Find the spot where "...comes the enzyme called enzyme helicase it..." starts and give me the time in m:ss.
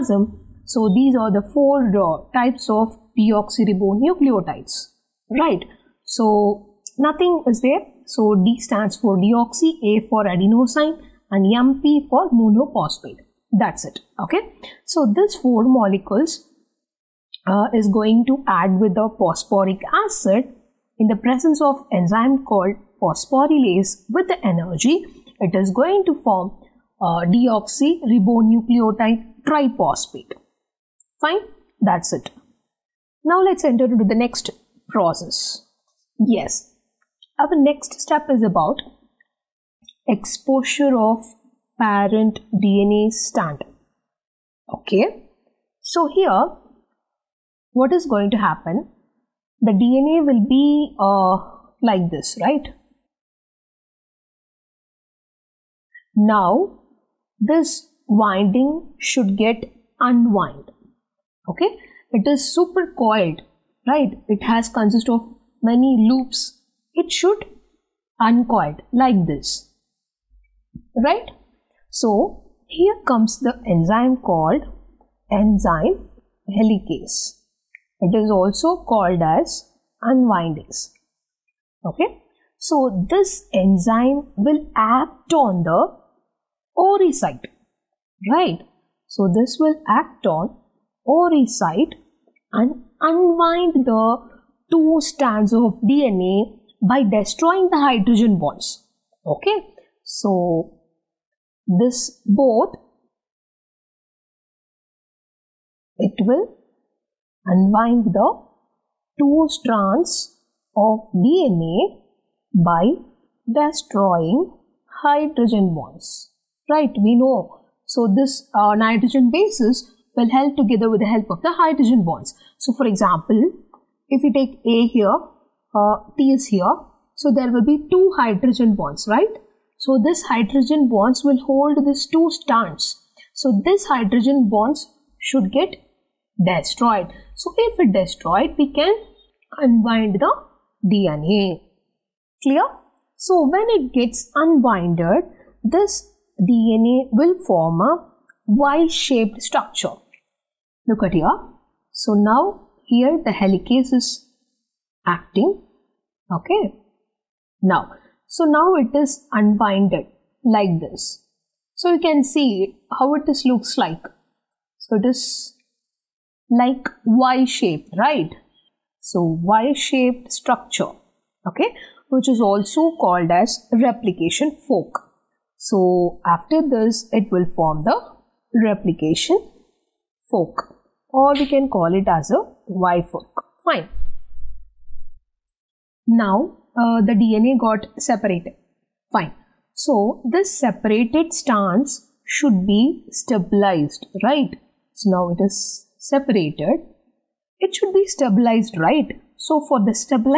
1:13.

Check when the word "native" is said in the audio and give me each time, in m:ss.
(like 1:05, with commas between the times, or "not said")
not said.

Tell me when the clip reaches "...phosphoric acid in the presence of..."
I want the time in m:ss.
0:19.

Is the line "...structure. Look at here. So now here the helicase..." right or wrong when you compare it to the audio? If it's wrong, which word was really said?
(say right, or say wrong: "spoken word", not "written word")
right.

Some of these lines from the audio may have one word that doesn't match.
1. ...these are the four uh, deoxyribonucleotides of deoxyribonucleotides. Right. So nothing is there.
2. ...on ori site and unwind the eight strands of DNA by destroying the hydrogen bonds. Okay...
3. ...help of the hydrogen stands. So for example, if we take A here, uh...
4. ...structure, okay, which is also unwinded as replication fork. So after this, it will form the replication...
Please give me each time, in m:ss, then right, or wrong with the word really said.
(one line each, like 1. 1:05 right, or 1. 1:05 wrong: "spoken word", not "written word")
1. 0:00 wrong: "types", not "deoxyribonucleotides"
2. 1:30 wrong: "two", not "eight"
3. 2:01 wrong: "bonds", not "stands"
4. 2:50 wrong: "called", not "unwinded".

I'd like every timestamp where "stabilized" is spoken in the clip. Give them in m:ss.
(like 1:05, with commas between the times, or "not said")
3:13, 3:18.